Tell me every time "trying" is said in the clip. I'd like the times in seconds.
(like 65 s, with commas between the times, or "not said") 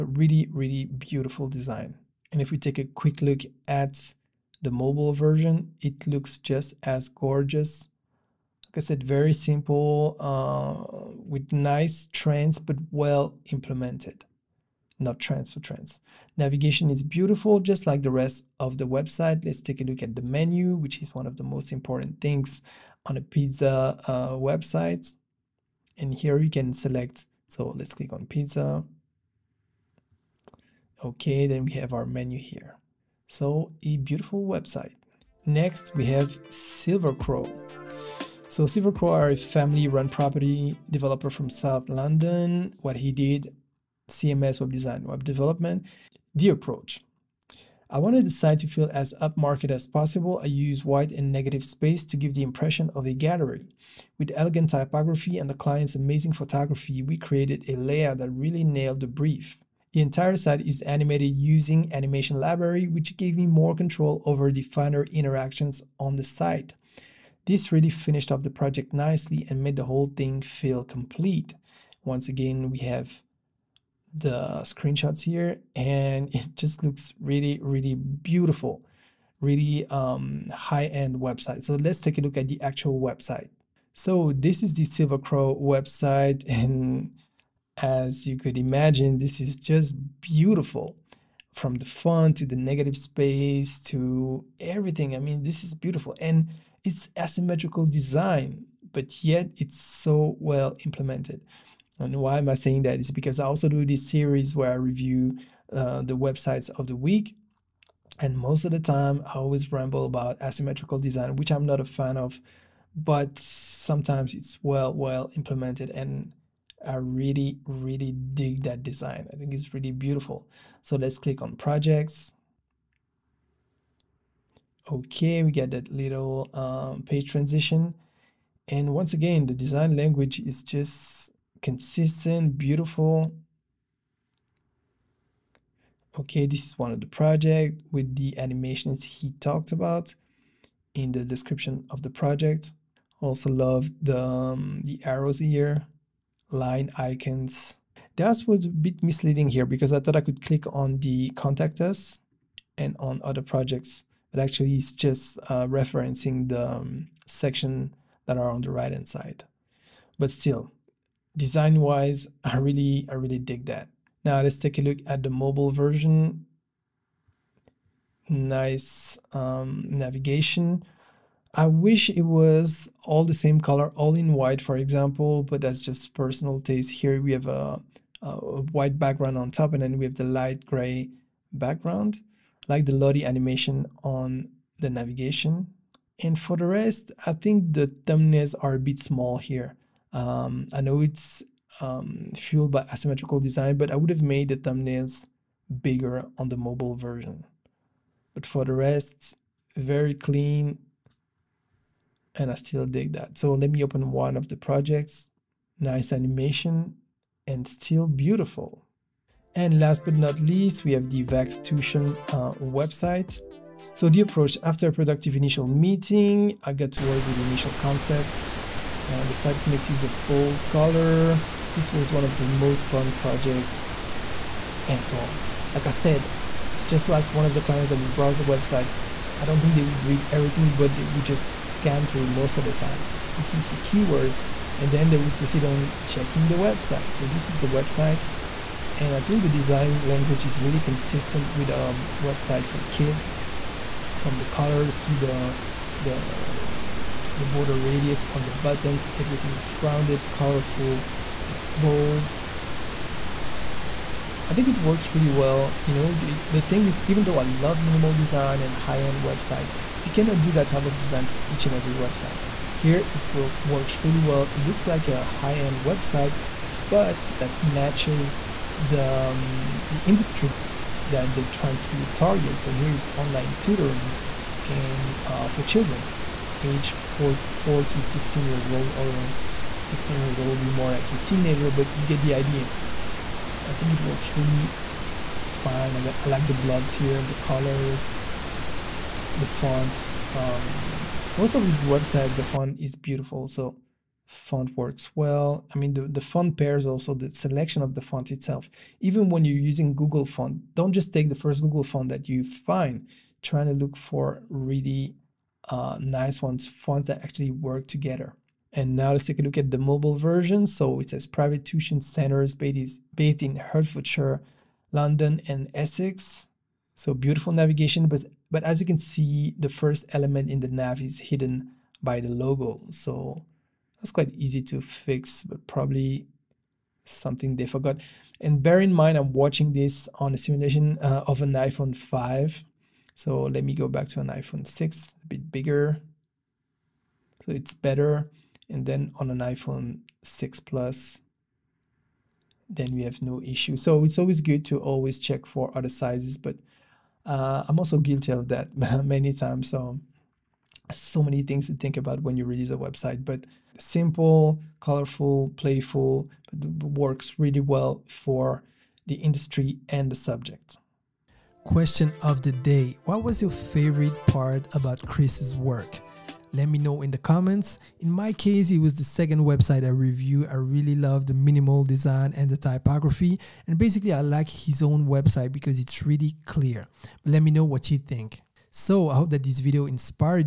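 271 s, 303 s.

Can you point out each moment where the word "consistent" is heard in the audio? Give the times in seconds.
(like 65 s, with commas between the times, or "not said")
131 s, 240 s.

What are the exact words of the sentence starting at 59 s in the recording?
The entire site is animated using Animation Library, which gave me more control over the finer interactions on the site.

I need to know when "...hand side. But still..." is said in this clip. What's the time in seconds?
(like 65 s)
158 s.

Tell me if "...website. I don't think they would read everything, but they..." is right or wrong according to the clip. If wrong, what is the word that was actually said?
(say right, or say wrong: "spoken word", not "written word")
right.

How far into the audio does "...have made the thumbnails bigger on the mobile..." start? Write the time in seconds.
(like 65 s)
194 s.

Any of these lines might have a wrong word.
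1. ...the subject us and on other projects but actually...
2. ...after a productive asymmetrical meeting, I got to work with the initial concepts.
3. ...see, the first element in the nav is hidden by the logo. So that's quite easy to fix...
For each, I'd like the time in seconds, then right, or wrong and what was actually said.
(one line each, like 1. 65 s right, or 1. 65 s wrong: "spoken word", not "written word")
1. 150 s wrong: "contact", not "subject"
2. 214 s wrong: "initial", not "asymmetrical"
3. 318 s right.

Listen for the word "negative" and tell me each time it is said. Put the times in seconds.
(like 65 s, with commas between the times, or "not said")
51 s, 92 s.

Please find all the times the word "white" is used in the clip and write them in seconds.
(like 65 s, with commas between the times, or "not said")
50 s, 174 s, 178 s.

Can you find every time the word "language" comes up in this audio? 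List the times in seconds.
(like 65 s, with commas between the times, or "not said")
129 s, 240 s.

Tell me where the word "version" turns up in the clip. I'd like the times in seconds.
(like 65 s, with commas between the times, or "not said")
5 s, 165 s, 196 s, 310 s.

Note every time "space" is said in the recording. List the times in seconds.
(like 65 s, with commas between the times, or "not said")
51 s, 92 s.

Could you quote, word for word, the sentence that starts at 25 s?
And here you can select, so let's click on pizza.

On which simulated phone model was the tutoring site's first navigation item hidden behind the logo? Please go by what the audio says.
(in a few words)
iPhone 5.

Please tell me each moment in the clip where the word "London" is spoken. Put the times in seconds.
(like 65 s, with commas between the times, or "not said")
41 s, 314 s.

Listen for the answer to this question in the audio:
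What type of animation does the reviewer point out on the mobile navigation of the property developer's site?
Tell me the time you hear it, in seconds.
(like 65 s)
182 s.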